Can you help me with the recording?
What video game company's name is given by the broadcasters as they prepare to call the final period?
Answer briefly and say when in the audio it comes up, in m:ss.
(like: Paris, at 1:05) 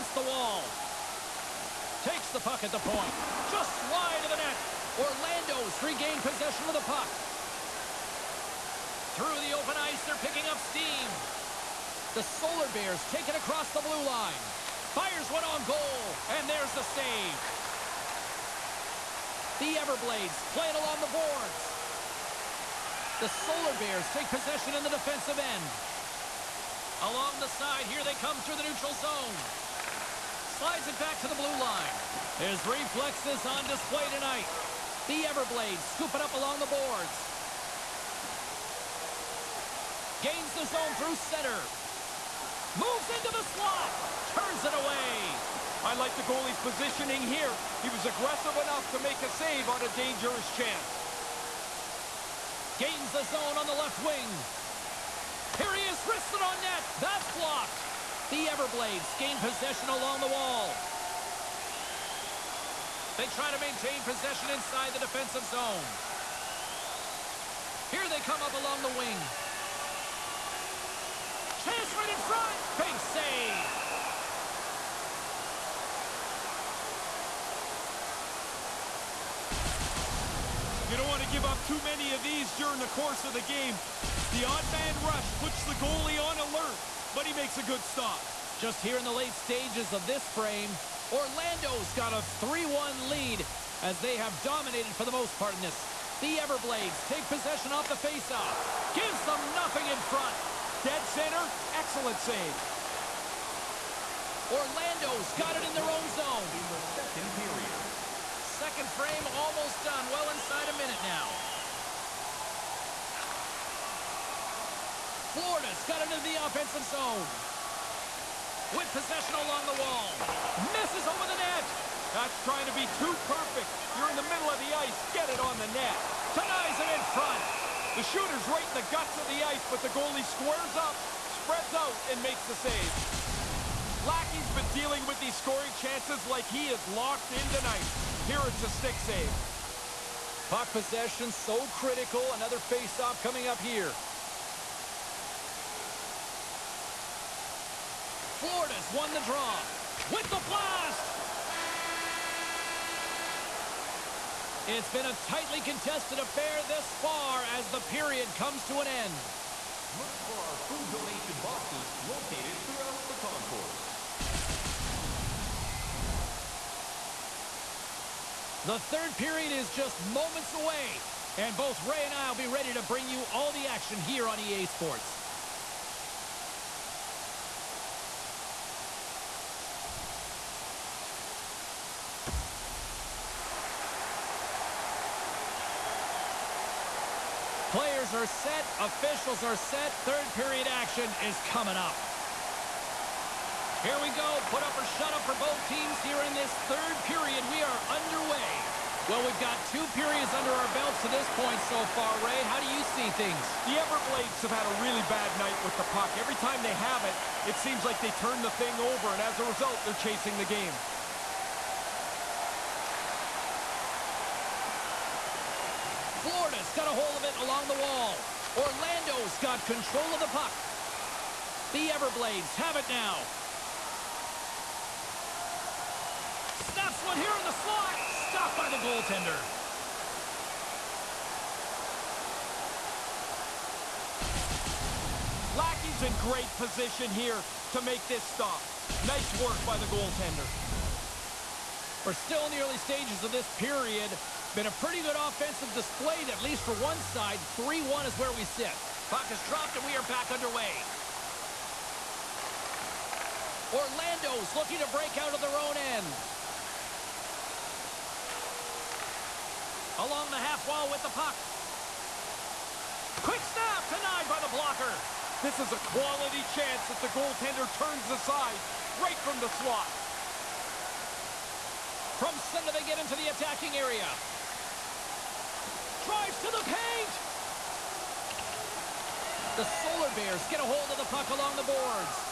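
EA Sports, at 2:54.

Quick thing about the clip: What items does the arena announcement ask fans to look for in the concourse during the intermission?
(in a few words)
food donation boxes.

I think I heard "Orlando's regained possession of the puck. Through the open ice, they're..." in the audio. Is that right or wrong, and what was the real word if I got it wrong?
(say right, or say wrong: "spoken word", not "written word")
right.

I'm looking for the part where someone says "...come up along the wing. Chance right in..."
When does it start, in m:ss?
1:08.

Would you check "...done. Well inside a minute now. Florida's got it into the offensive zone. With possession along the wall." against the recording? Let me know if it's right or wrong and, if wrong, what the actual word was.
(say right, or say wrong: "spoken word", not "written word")
right.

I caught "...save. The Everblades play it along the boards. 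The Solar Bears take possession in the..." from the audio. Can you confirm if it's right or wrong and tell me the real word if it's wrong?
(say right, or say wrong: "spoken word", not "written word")
right.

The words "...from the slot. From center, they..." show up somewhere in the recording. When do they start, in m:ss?
4:29.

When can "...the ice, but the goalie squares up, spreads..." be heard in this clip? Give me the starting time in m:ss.
2:09.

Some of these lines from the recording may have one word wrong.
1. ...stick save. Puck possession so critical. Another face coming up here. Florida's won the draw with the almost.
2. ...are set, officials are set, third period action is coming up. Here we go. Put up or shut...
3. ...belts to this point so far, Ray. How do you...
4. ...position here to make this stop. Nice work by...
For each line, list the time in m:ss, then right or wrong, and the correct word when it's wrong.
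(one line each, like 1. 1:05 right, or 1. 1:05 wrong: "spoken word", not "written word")
1. 2:18 wrong: "blast", not "almost"
2. 3:08 right
3. 3:20 right
4. 3:56 right.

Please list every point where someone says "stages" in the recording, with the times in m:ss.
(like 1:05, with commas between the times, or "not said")
1:29, 4:02.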